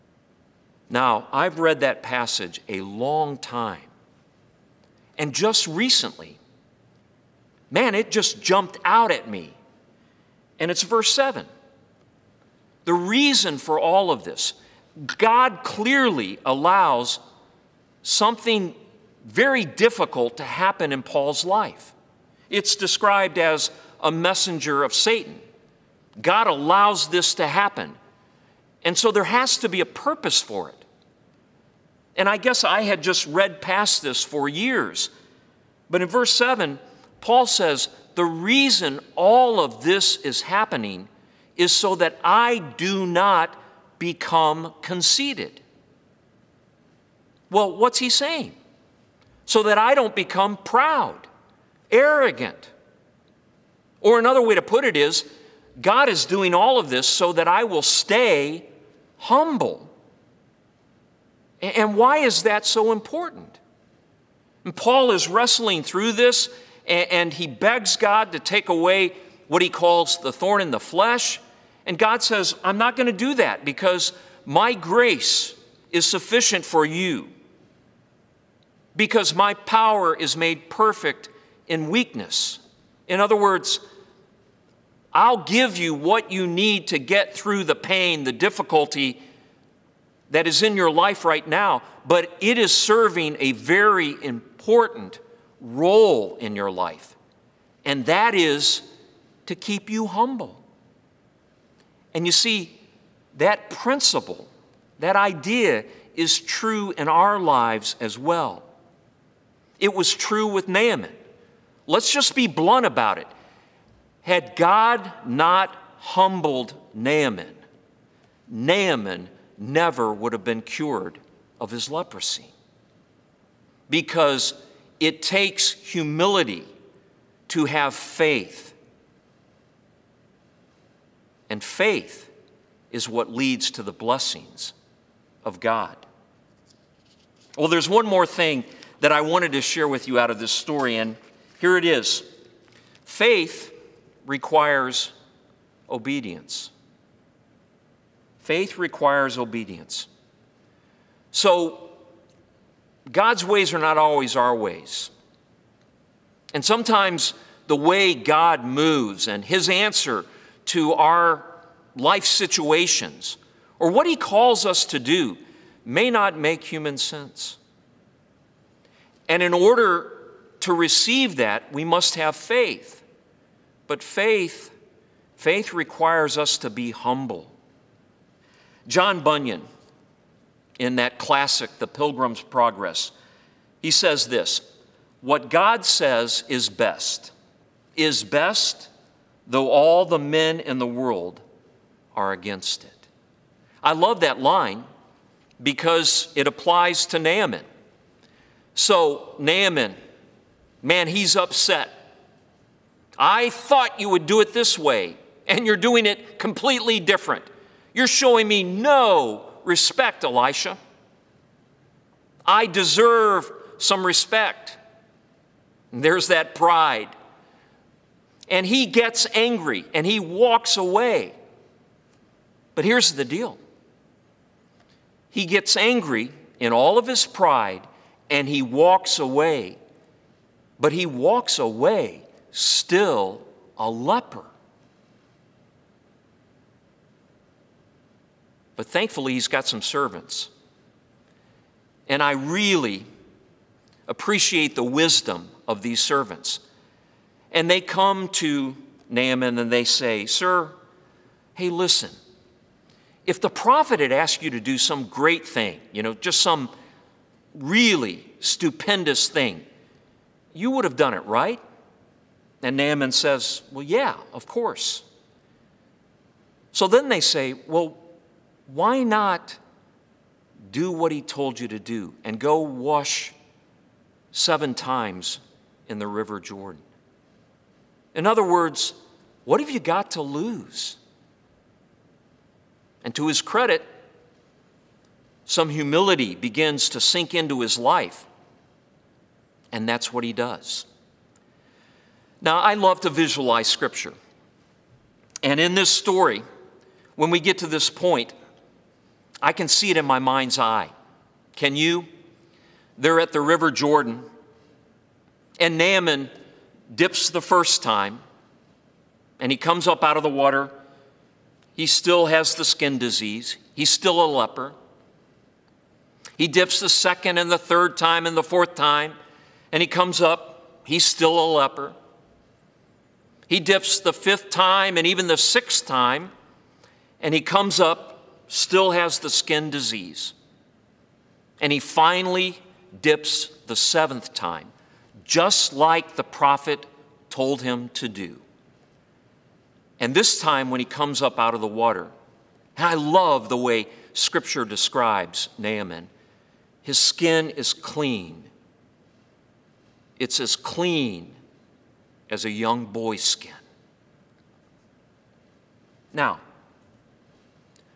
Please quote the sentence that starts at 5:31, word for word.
And he finally dips the seventh time, just like the prophet told him to do.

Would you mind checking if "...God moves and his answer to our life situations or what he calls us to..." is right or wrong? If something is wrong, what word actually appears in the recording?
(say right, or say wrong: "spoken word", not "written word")
right.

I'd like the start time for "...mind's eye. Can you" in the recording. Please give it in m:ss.
5:00.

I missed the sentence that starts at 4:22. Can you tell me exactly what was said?
And Naaman says, Well, yeah, of course.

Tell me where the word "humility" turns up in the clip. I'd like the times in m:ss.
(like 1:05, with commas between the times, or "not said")
2:05, 4:45.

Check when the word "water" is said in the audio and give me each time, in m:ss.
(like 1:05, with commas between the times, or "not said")
5:10, 5:41.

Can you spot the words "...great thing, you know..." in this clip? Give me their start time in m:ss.
4:15.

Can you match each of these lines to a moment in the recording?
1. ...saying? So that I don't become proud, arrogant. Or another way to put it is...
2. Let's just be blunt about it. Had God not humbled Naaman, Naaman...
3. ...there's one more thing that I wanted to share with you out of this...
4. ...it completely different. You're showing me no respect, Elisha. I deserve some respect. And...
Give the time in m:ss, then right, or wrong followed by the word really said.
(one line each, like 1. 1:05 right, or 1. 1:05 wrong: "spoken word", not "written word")
1. 0:48 right
2. 1:51 right
3. 2:17 right
4. 3:26 right.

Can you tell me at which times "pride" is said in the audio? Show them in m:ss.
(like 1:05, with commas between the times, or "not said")
3:36, 3:47.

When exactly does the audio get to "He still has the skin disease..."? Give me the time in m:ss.
5:11.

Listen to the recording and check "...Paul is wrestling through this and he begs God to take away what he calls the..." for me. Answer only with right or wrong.
right.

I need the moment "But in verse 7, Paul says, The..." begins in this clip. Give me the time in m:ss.
0:35.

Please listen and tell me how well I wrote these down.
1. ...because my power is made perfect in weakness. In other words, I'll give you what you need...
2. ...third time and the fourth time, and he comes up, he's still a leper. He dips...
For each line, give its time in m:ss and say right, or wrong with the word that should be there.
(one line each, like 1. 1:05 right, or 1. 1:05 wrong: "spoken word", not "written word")
1. 1:18 right
2. 5:17 right.